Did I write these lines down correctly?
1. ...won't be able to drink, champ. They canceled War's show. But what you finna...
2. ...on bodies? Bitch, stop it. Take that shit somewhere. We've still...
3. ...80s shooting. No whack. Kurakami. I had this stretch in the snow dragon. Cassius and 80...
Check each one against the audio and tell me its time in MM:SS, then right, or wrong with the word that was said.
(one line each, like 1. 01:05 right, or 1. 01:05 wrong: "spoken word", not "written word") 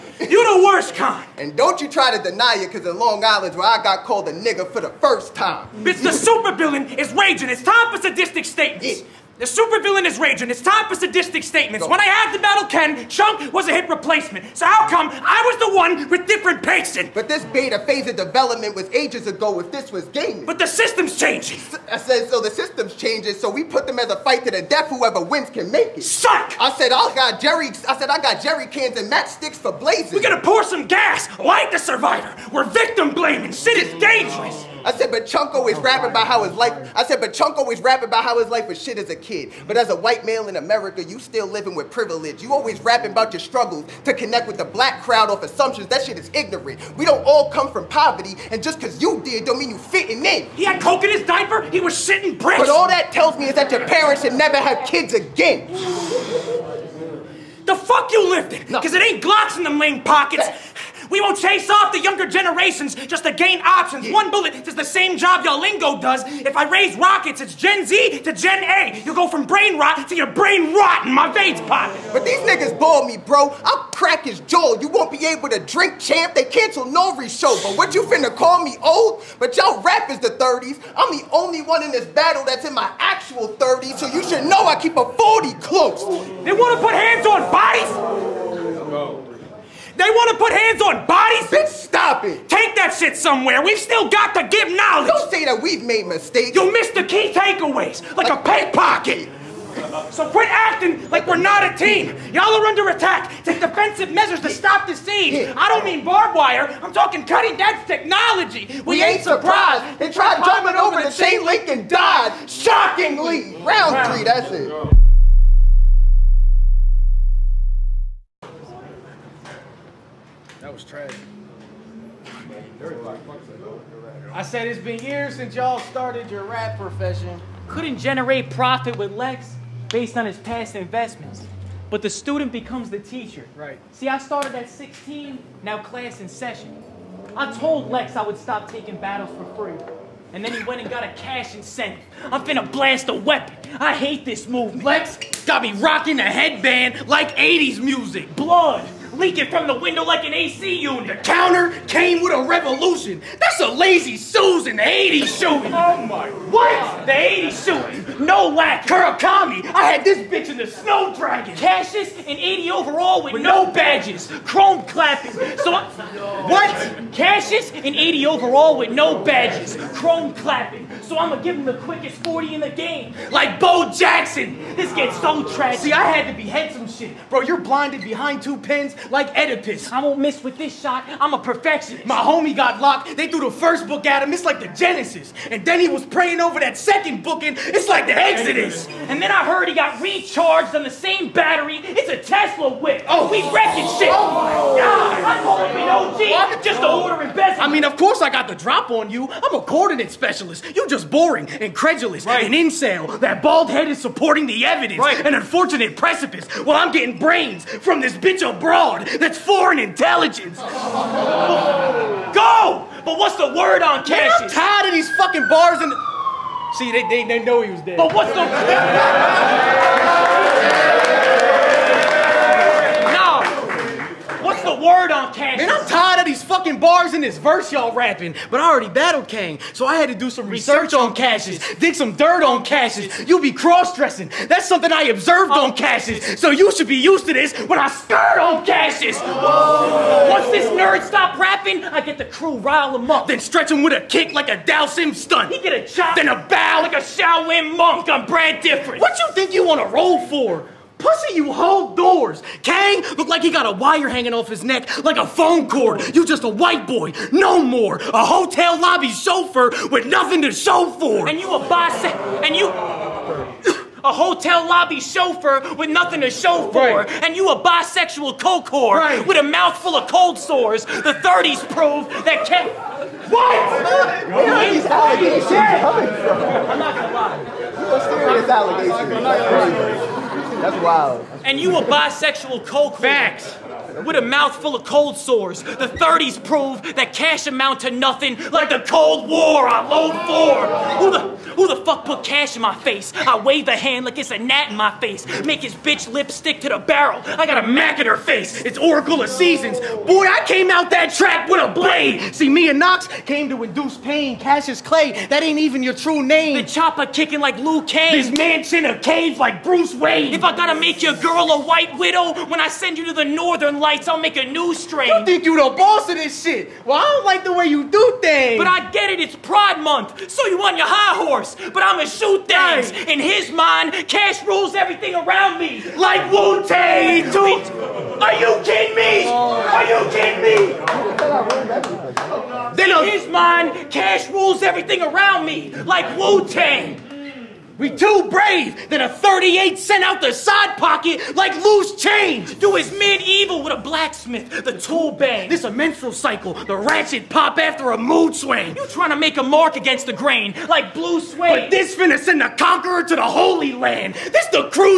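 1. 01:14 wrong: "Nori", not "War"
2. 01:30 right
3. 02:37 wrong: "bitch", not "stretch".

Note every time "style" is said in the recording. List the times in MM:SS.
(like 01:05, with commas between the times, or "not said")
not said.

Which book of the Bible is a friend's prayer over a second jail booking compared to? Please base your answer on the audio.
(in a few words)
Exodus.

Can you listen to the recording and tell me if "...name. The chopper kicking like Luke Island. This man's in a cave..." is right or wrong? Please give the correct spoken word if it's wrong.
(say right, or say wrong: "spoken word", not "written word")
wrong: "Kane", not "Island".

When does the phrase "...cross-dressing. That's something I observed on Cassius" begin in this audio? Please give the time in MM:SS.
03:53.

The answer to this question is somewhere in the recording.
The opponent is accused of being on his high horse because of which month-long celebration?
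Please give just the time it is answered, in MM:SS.
05:19.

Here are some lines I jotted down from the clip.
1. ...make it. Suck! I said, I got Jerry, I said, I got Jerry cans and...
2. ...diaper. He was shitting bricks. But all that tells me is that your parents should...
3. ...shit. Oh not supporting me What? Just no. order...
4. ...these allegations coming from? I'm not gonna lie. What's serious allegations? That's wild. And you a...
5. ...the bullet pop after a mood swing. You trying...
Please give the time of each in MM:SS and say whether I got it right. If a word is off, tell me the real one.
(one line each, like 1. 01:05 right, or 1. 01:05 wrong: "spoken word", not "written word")
1. 00:25 right
2. 00:51 right
3. 03:13 wrong: "calling", not "supporting"
4. 04:34 right
5. 05:46 wrong: "ratchet", not "bullet".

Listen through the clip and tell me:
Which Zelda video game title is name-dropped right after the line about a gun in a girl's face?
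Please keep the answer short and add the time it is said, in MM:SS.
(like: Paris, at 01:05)
Oracle of Seasons, at 04:58.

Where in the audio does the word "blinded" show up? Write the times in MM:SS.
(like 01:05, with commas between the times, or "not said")
02:57.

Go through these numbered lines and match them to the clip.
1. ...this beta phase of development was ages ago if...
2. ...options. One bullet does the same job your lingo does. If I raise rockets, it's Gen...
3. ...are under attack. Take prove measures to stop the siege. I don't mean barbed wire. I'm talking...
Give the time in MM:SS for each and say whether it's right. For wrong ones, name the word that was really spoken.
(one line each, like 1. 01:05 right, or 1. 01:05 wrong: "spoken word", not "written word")
1. 00:17 right
2. 01:03 right
3. 01:42 wrong: "defensive", not "prove".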